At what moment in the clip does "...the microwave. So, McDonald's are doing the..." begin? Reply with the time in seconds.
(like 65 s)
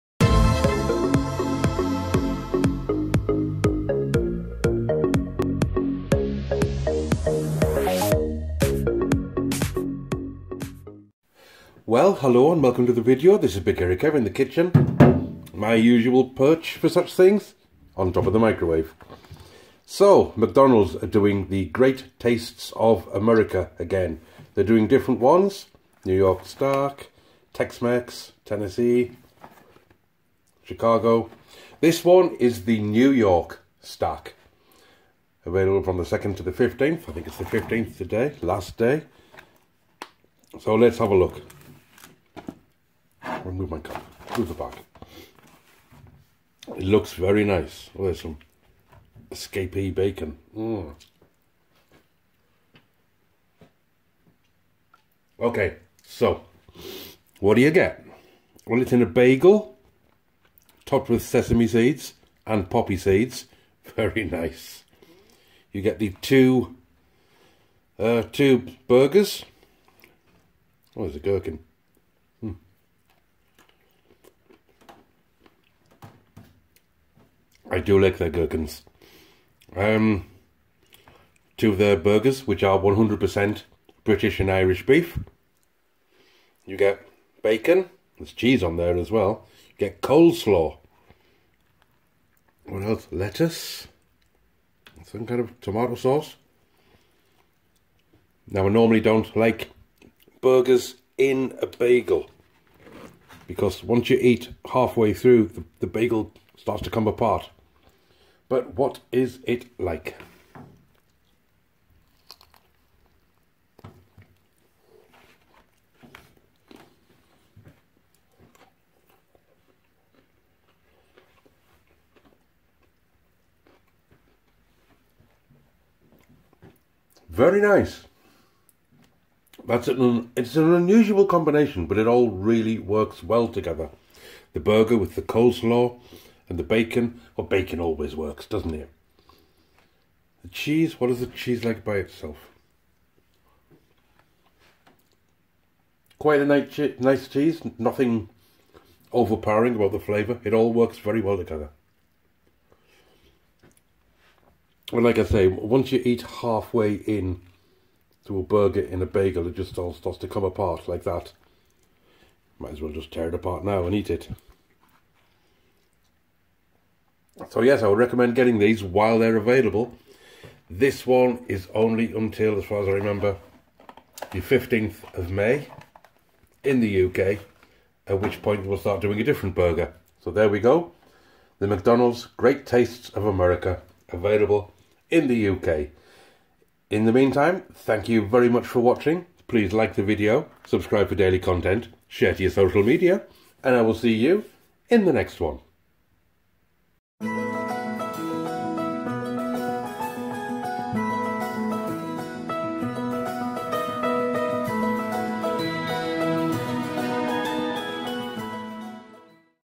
18 s.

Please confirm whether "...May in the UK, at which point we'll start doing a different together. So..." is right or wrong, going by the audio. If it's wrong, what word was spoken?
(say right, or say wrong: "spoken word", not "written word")
wrong: "burger", not "together".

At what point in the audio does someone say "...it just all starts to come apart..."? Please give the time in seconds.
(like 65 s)
159 s.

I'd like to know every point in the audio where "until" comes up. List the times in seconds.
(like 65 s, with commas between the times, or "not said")
172 s.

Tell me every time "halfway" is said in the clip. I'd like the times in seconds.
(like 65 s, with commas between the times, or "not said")
104 s, 156 s.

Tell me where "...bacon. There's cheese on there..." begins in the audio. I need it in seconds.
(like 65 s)
87 s.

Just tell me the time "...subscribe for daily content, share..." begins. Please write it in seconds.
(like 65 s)
190 s.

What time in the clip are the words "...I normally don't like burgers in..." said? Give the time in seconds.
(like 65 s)
98 s.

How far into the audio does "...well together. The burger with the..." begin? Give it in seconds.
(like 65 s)
133 s.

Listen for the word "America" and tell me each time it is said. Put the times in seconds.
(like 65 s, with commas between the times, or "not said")
23 s, 183 s.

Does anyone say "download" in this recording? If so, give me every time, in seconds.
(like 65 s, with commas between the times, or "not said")
not said.